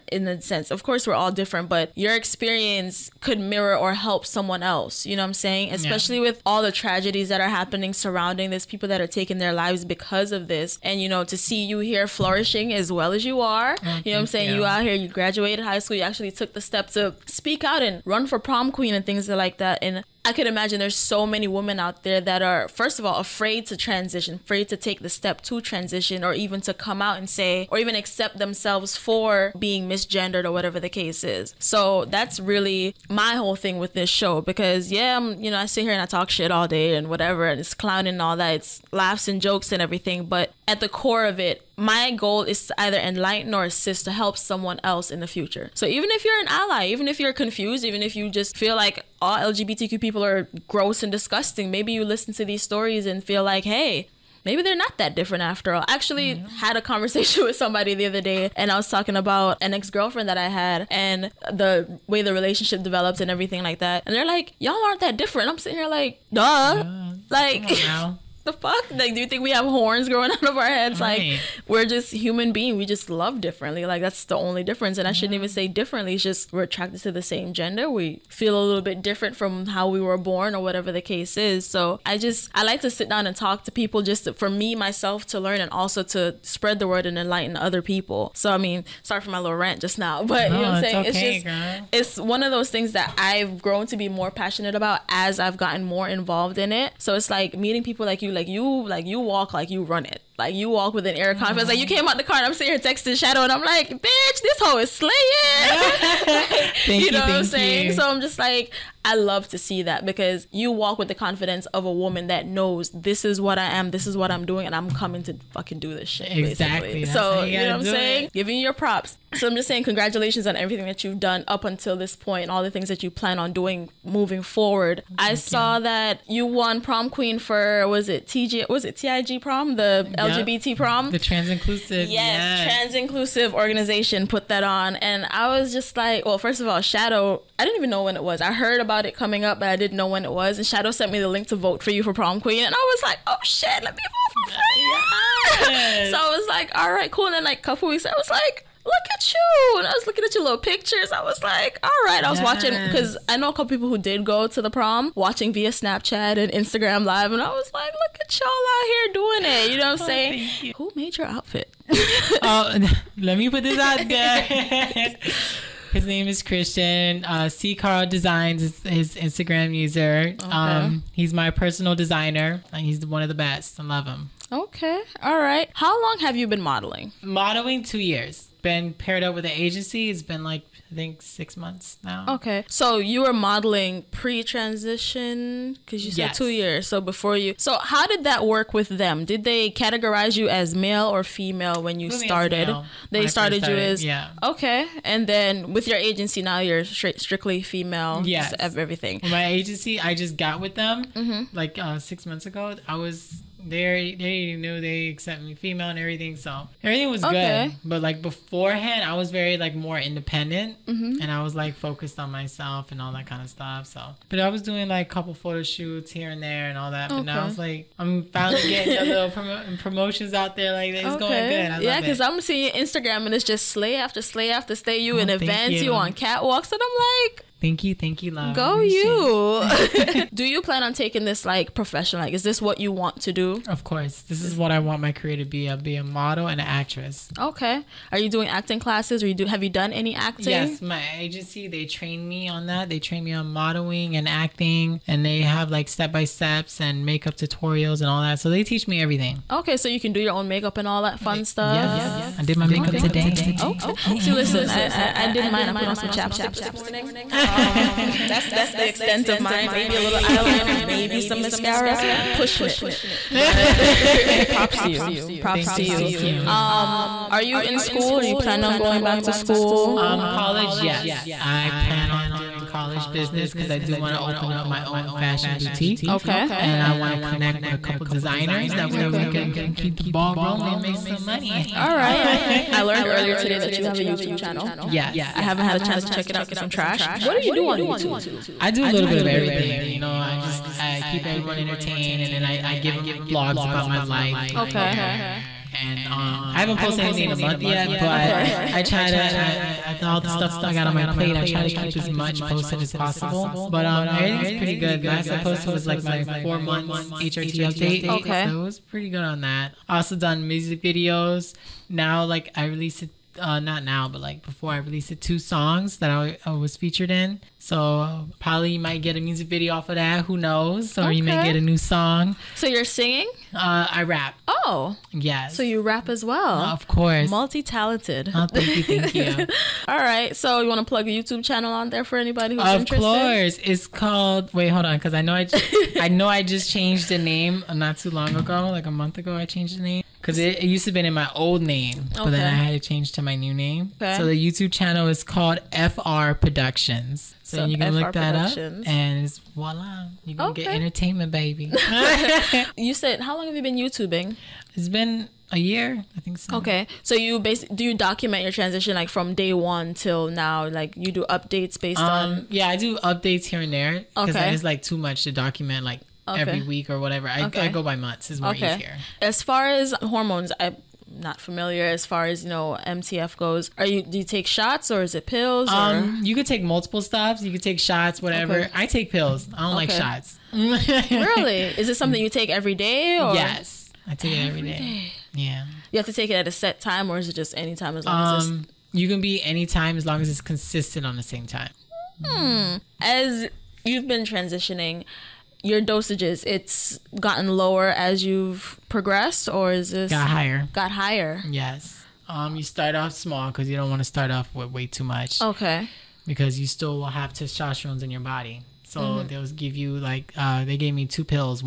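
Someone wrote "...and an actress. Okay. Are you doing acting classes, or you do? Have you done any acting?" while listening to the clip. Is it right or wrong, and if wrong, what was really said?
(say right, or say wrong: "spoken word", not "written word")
right.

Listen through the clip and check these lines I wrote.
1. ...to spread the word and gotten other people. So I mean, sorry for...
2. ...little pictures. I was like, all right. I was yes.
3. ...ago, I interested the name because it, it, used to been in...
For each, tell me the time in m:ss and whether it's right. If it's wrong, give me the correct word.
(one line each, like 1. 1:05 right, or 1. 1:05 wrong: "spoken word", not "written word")
1. 1:26 wrong: "enlighten", not "gotten"
2. 2:30 right
3. 5:39 wrong: "changed", not "interested".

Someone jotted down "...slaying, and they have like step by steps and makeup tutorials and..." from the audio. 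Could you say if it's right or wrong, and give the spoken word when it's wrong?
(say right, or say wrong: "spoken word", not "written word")
wrong: "acting", not "slaying".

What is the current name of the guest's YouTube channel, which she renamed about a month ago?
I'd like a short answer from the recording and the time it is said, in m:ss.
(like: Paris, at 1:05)
FR Productions, at 5:45.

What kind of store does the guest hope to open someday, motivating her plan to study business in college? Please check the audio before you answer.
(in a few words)
Fashion boutique.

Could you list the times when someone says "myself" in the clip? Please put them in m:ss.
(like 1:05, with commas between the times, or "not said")
1:24, 3:32.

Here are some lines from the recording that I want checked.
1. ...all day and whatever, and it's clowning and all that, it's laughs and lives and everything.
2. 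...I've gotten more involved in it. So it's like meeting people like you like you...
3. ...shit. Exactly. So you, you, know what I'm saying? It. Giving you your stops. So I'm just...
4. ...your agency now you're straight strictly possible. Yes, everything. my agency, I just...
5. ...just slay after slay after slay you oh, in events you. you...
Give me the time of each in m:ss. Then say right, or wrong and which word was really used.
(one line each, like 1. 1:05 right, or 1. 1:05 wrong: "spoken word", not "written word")
1. 0:36 wrong: "jokes", not "lives"
2. 1:35 right
3. 1:56 wrong: "props", not "stops"
4. 3:15 wrong: "female", not "possible"
5. 3:43 right.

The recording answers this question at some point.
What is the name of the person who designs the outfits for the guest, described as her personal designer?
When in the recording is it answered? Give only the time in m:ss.
2:46.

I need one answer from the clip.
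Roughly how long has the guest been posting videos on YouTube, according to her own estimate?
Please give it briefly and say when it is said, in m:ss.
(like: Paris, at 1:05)
A year, at 5:55.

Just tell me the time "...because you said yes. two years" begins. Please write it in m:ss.
3:05.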